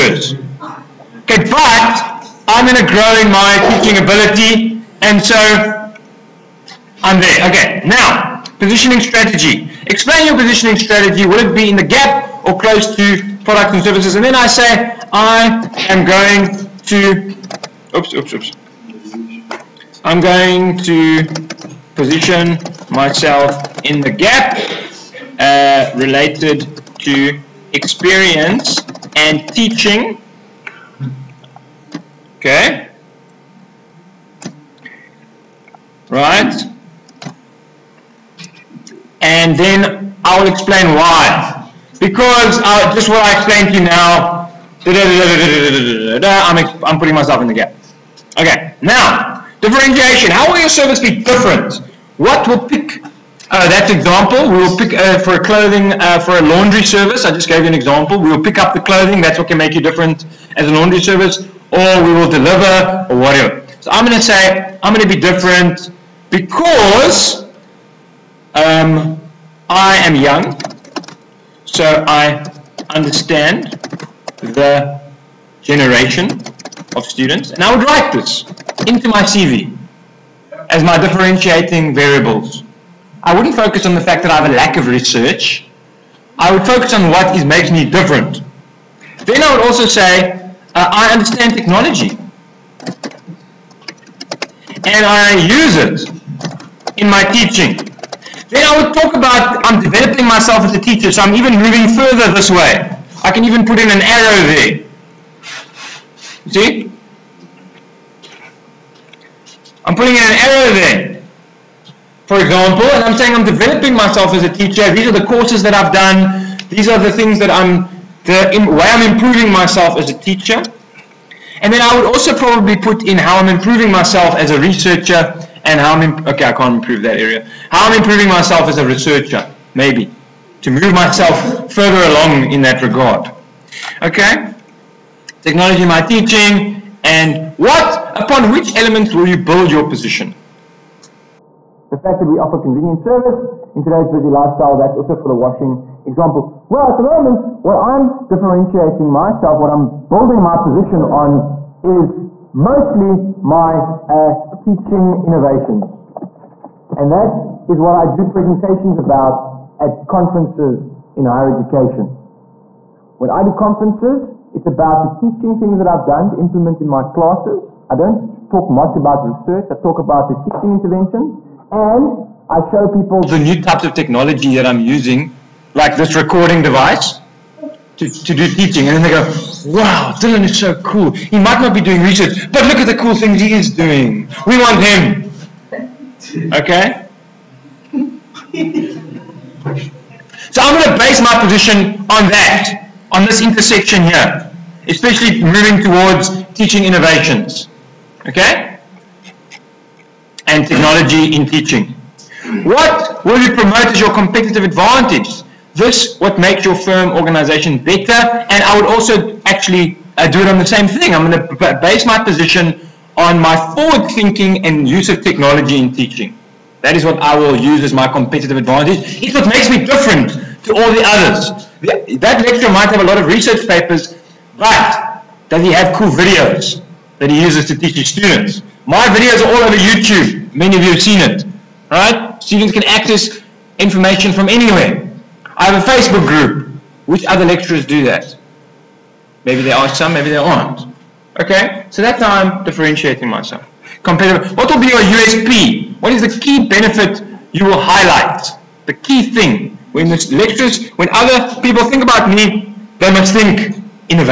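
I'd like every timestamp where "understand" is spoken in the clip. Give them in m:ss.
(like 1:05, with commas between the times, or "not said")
1:12, 1:31.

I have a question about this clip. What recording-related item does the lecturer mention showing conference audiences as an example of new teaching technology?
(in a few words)
Recording device.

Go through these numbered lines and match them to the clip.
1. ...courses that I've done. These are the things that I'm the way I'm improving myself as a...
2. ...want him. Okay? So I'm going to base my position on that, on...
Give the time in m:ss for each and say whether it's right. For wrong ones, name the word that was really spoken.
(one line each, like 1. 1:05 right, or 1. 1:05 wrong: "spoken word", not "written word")
1. 1:55 right
2. 3:04 right.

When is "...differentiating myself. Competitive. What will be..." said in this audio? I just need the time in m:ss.
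4:02.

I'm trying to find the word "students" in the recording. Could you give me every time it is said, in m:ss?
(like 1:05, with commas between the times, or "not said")
1:17, 3:48, 3:52.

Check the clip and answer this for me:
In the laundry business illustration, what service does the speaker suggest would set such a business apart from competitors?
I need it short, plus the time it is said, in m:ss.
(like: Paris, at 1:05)
Pick up the clothing, at 0:58.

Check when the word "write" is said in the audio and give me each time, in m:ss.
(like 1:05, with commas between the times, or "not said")
1:17.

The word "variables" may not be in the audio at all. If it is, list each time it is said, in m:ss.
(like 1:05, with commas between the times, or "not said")
1:21.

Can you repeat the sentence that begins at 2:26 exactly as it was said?
Well, at the moment, what I'm differentiating myself, what I'm building my position on is mostly my uh, teaching innovations.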